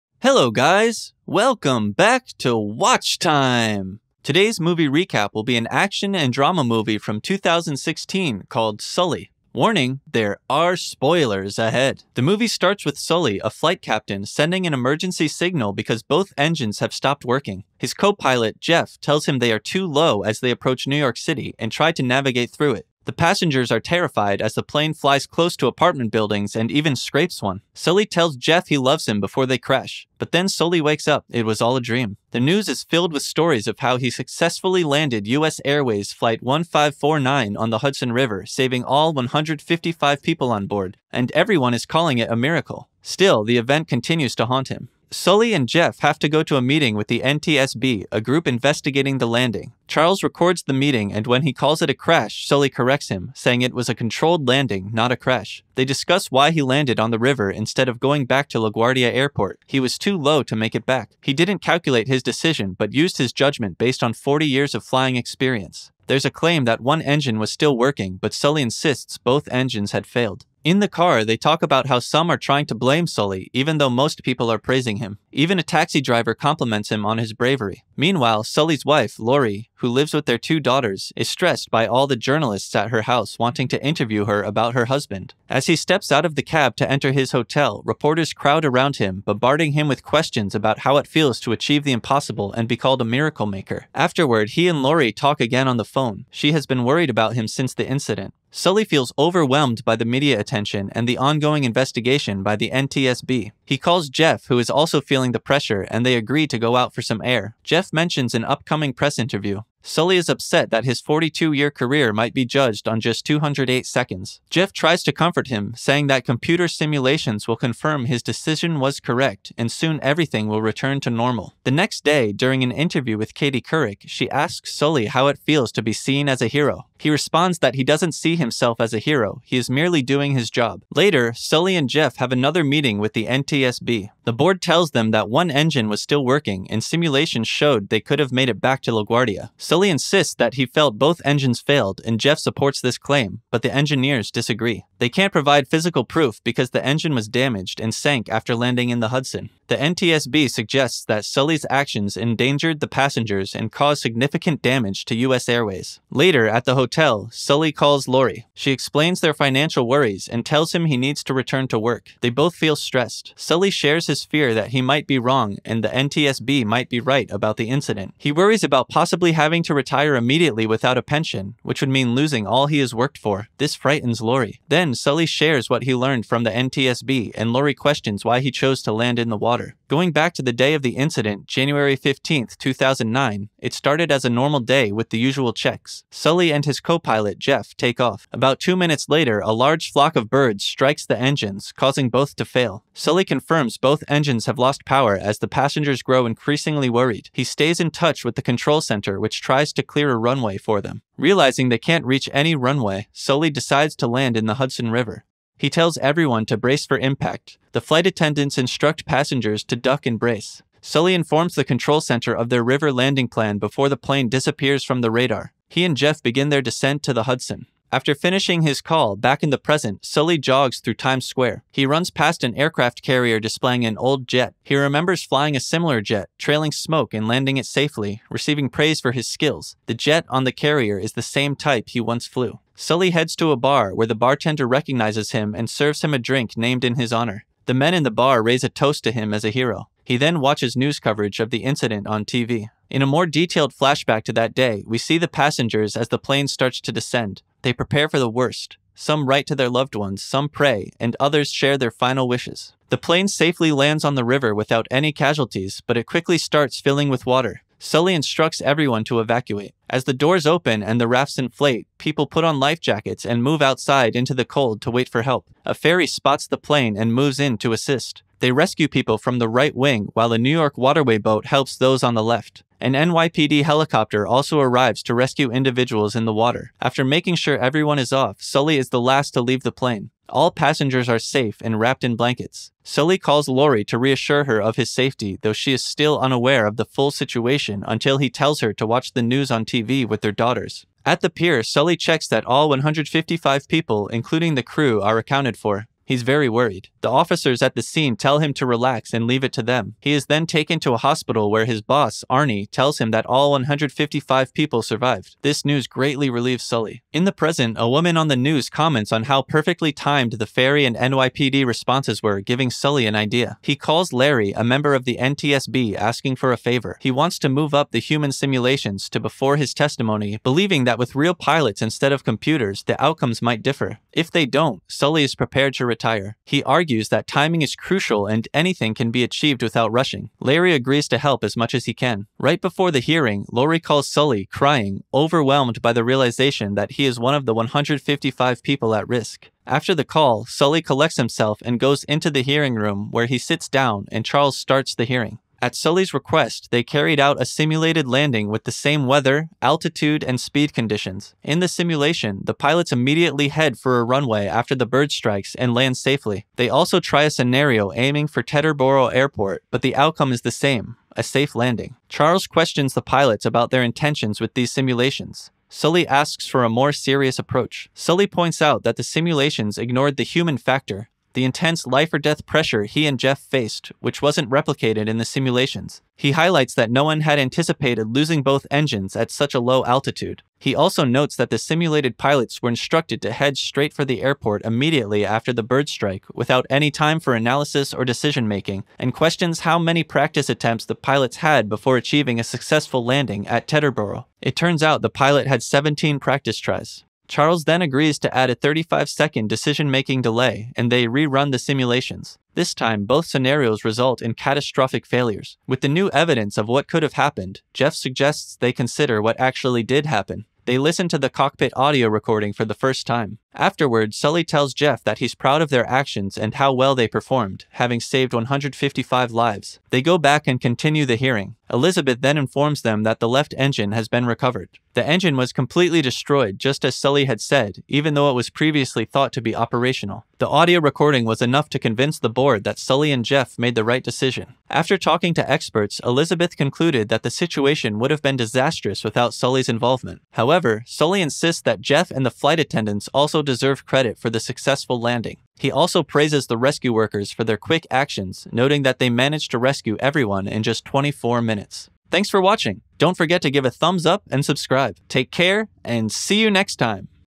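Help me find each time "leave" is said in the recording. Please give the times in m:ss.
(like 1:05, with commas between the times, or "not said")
4:39, 4:59.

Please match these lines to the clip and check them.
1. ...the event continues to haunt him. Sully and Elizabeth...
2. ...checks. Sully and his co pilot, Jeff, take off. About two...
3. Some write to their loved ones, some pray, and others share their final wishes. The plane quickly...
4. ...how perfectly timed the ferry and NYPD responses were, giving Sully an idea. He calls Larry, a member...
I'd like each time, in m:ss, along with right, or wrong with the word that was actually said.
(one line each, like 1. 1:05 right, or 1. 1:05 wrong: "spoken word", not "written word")
1. 0:43 wrong: "Jeff", not "Elizabeth"
2. 3:05 right
3. 4:08 wrong: "safely", not "quickly"
4. 5:09 right.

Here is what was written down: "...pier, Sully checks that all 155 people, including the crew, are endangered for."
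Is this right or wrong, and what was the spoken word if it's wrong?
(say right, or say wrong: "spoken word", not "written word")
wrong: "accounted", not "endangered".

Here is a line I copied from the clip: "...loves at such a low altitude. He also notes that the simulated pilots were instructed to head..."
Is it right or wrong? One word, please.
wrong.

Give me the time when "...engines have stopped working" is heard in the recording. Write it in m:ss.
0:16.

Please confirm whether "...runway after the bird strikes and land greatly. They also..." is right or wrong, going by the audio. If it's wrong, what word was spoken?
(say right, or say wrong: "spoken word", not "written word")
wrong: "safely", not "greatly".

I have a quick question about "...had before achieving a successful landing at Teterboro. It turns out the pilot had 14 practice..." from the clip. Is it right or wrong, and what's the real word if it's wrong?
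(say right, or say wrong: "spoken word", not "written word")
wrong: "17", not "14".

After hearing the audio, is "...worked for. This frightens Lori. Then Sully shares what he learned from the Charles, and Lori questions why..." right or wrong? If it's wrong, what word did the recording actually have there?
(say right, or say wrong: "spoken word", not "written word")
wrong: "NTSB", not "Charles".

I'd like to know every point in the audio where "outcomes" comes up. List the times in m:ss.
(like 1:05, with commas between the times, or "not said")
5:23, 5:59.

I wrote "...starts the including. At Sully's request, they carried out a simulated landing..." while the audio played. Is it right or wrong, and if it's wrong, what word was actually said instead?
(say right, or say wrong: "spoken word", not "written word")
wrong: "hearing", not "including".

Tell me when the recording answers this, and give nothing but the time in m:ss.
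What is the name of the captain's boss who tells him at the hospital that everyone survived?
5:02.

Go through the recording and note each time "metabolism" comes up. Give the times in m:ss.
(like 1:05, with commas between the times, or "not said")
not said.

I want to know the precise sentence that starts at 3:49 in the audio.
The jet on the carrier is the same type he once flew.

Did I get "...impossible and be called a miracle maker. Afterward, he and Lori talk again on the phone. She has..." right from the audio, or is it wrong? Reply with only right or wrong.
right.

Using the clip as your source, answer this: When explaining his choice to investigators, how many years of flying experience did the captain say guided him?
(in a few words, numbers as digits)
40.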